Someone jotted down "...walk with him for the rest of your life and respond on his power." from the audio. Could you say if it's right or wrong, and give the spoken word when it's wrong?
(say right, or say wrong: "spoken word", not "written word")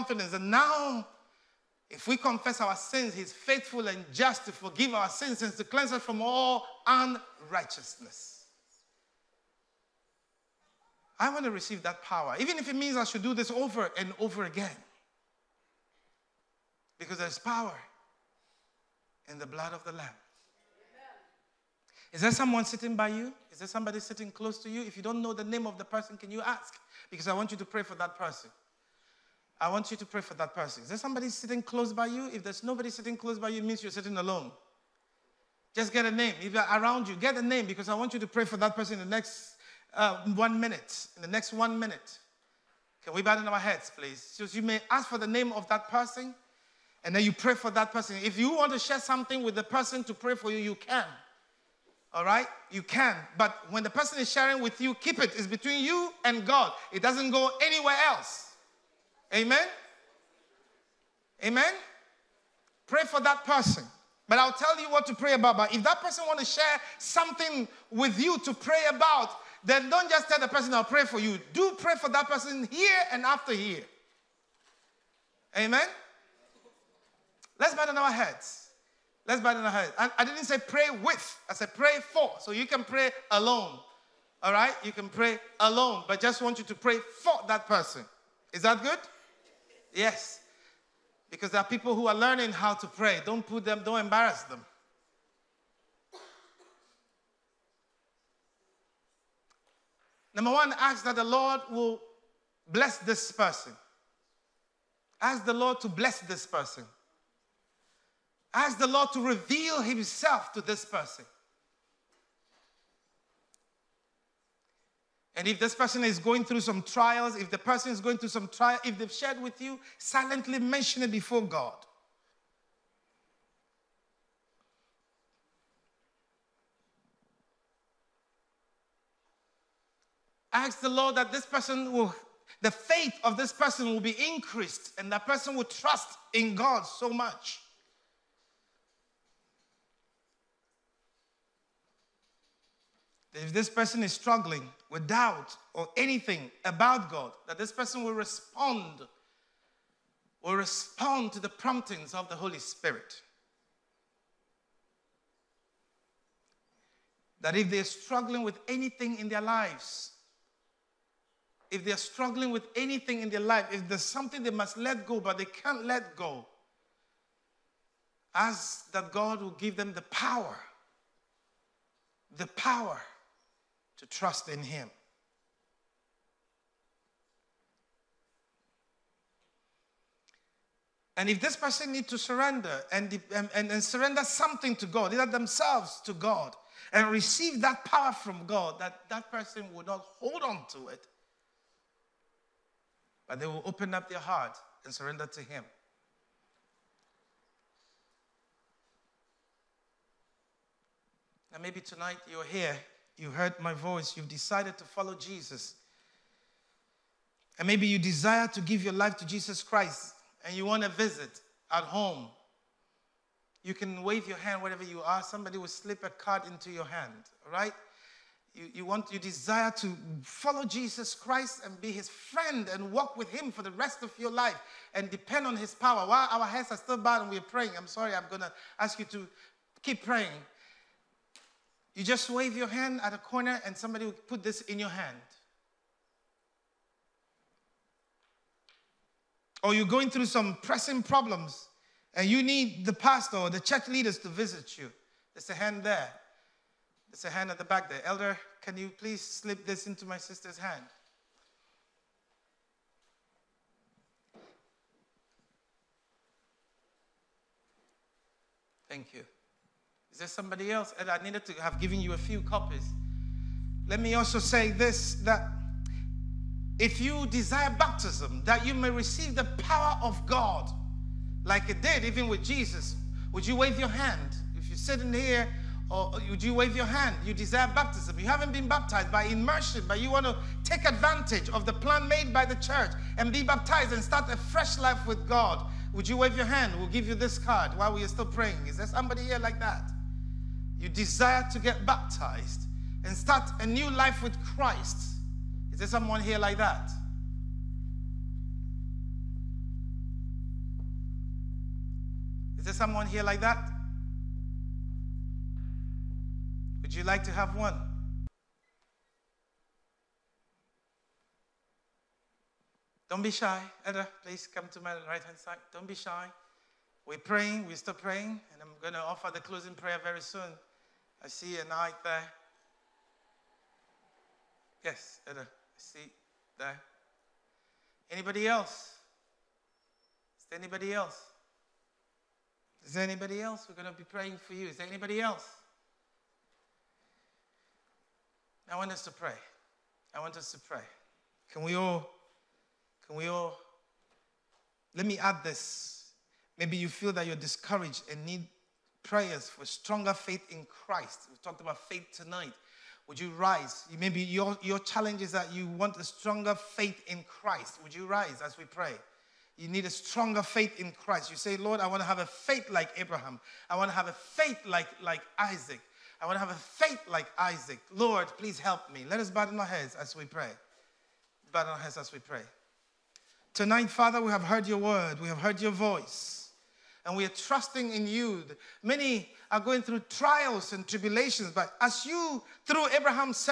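wrong: "depend", not "respond".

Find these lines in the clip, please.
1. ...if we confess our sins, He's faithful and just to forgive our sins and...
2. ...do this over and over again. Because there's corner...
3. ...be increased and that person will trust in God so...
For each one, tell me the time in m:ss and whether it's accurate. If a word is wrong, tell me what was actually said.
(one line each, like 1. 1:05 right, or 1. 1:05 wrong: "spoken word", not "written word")
1. 0:01 right
2. 0:13 wrong: "power", not "corner"
3. 2:13 right.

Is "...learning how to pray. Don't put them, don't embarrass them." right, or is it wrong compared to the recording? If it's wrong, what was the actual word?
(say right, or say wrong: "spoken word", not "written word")
right.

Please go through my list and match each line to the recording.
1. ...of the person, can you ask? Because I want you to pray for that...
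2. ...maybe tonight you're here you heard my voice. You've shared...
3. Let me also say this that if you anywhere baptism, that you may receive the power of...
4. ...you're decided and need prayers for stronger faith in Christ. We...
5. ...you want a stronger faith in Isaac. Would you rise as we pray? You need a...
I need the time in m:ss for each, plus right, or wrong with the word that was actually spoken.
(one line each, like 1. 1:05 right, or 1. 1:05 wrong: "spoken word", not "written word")
1. 0:25 right
2. 3:21 wrong: "decided", not "shared"
3. 4:23 wrong: "desire", not "anywhere"
4. 5:47 wrong: "discouraged", not "decided"
5. 5:55 wrong: "Christ", not "Isaac".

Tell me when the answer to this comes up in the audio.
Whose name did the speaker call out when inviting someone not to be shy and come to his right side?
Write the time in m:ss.
5:13.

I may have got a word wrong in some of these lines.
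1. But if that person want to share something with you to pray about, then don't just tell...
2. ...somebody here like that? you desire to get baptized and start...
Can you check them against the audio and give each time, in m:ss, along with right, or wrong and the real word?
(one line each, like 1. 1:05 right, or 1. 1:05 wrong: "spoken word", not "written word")
1. 1:05 right
2. 4:48 right.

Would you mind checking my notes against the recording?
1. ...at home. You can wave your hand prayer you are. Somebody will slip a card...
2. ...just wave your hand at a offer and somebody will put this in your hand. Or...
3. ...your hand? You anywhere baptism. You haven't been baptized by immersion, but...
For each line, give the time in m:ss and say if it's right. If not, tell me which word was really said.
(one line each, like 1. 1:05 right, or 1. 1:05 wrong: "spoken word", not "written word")
1. 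3:31 wrong: "wherever", not "prayer"
2. 3:52 wrong: "corner", not "offer"
3. 4:36 wrong: "desire", not "anywhere".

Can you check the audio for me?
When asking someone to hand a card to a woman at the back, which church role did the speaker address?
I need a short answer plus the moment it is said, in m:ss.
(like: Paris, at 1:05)
Elder, at 4:08.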